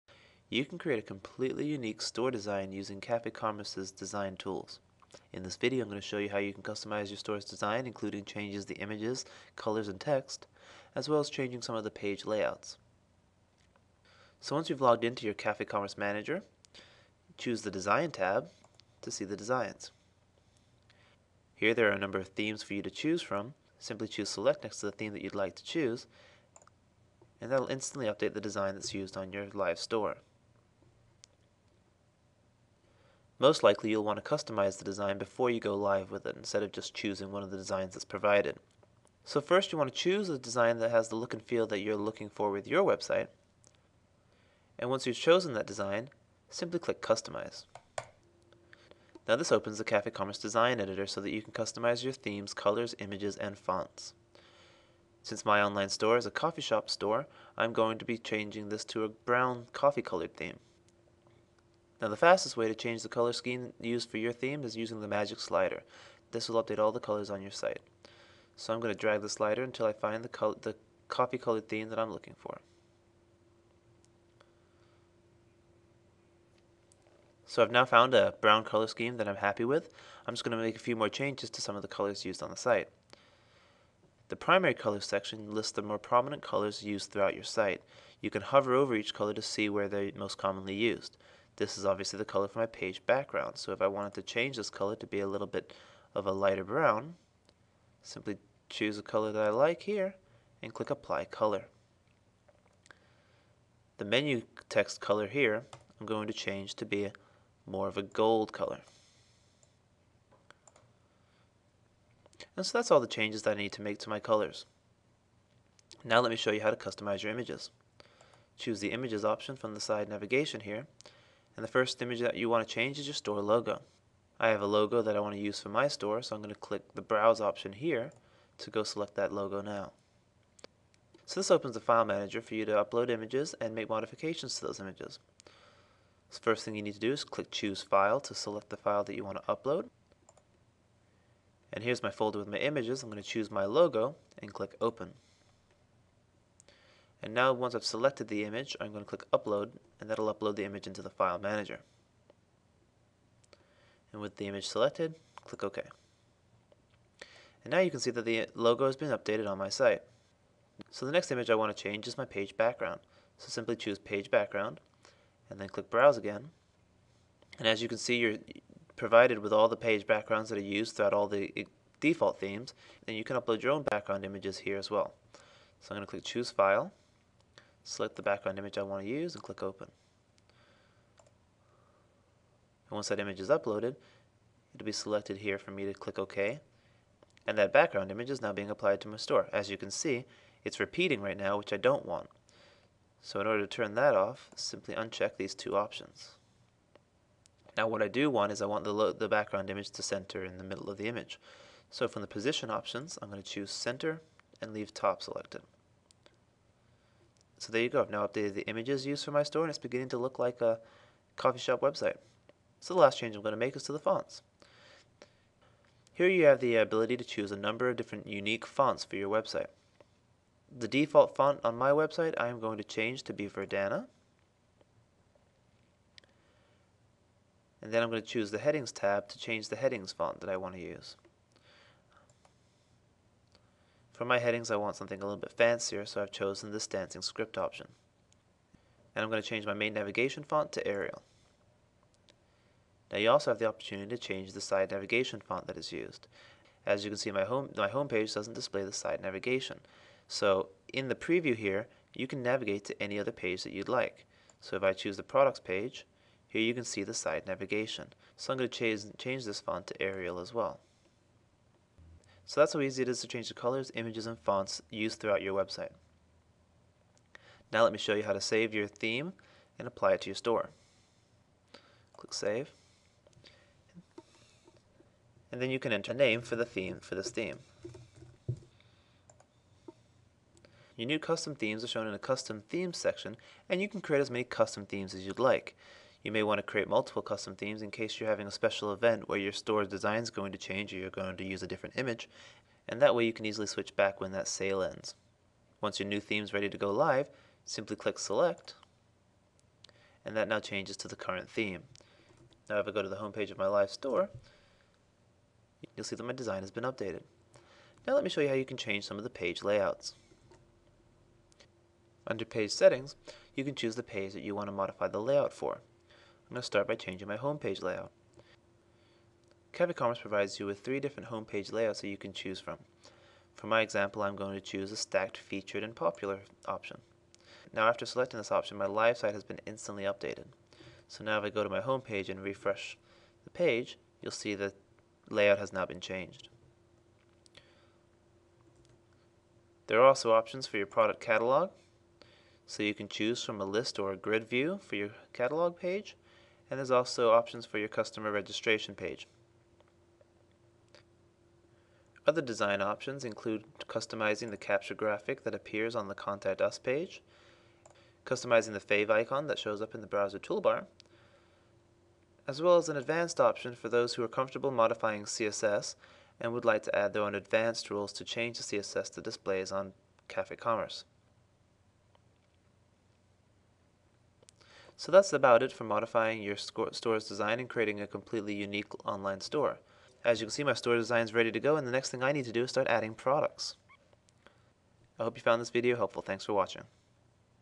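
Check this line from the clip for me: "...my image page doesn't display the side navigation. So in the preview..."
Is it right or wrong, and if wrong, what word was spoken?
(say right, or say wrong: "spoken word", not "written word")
wrong: "homepage", not "image".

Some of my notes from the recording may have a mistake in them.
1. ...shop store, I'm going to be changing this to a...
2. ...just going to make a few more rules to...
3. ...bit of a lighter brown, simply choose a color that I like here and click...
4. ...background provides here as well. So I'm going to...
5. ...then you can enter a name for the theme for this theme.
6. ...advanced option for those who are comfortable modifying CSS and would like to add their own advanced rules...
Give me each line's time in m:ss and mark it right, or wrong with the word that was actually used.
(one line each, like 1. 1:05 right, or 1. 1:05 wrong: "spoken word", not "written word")
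1. 0:56 right
2. 1:20 wrong: "changes", not "rules"
3. 1:35 right
4. 2:53 wrong: "images", not "provides"
5. 4:35 right
6. 6:02 right.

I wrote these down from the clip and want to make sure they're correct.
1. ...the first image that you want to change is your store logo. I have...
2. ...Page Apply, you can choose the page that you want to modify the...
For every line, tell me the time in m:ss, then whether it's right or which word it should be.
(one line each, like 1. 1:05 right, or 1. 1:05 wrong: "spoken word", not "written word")
1. 2:01 right
2. 5:12 wrong: "Settings", not "Apply".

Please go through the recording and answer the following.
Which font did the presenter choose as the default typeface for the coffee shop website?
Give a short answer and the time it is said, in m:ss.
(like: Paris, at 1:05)
Verdana, at 3:43.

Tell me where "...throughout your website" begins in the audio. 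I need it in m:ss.
4:25.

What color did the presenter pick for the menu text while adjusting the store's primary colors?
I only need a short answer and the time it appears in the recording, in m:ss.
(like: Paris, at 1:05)
Gold, at 1:48.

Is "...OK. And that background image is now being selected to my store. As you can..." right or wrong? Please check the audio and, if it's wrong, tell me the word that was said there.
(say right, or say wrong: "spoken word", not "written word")
wrong: "applied", not "selected".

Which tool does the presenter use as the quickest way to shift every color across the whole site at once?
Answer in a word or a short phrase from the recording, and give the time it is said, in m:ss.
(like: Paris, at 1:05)
Magic slider, at 1:05.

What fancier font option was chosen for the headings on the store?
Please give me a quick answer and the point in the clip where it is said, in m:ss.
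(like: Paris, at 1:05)
Dancing Script, at 3:56.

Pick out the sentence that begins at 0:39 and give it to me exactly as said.
So first you want to choose a design that has the look and feel that you're looking for with your website.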